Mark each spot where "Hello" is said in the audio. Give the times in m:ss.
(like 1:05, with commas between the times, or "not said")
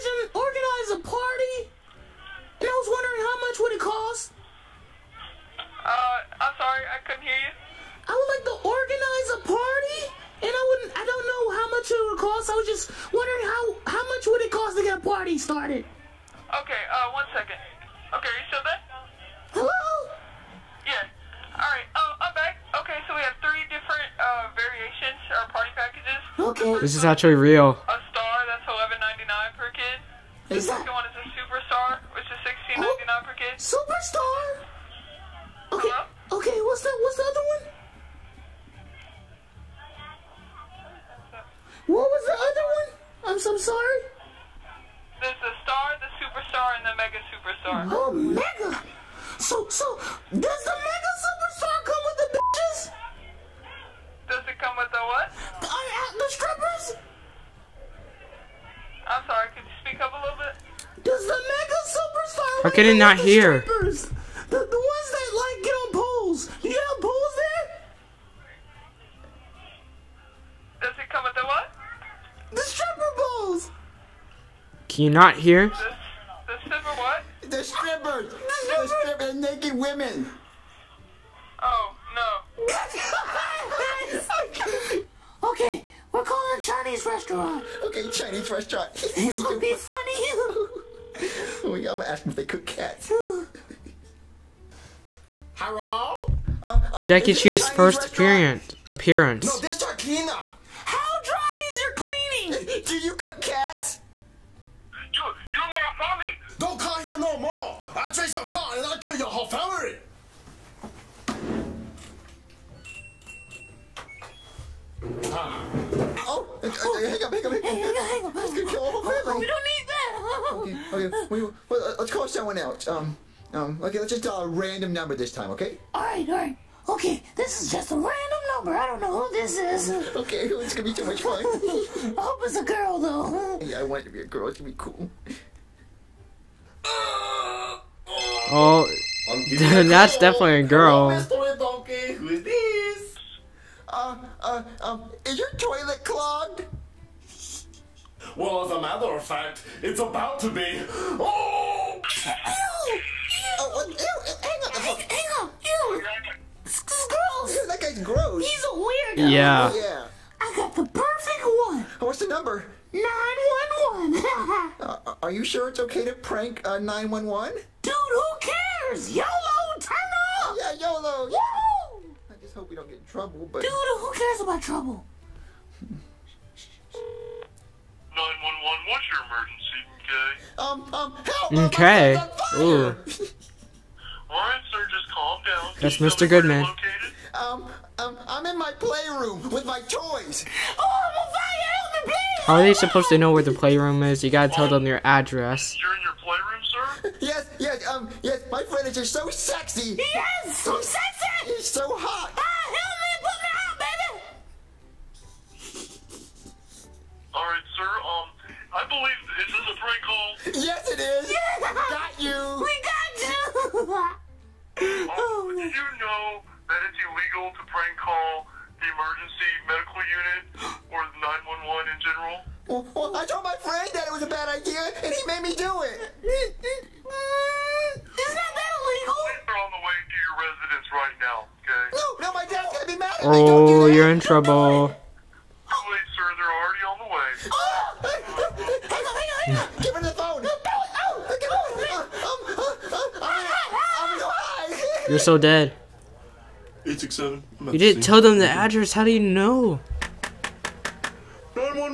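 0:19, 0:35, 1:35, 2:21.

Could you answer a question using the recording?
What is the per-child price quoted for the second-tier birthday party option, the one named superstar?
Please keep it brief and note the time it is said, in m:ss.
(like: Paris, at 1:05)
$16.99, at 0:32.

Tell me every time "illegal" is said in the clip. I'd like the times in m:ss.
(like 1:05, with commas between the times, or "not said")
3:36, 3:48.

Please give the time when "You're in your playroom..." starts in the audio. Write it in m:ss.
3:15.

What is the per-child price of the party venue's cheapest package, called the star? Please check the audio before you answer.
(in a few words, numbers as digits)
$11.99.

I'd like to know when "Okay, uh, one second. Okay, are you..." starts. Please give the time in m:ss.
0:16.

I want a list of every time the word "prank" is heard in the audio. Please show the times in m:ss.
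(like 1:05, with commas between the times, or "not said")
2:46, 3:37.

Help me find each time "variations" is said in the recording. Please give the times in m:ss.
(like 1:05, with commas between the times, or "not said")
0:24.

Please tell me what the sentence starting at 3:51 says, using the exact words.
No, no, my dad's gonna be mad at me.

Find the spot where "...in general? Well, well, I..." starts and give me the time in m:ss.
3:41.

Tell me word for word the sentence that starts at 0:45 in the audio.
There's the star, the superstar, and the mega superstar.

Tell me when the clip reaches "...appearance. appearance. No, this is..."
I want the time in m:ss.
1:38.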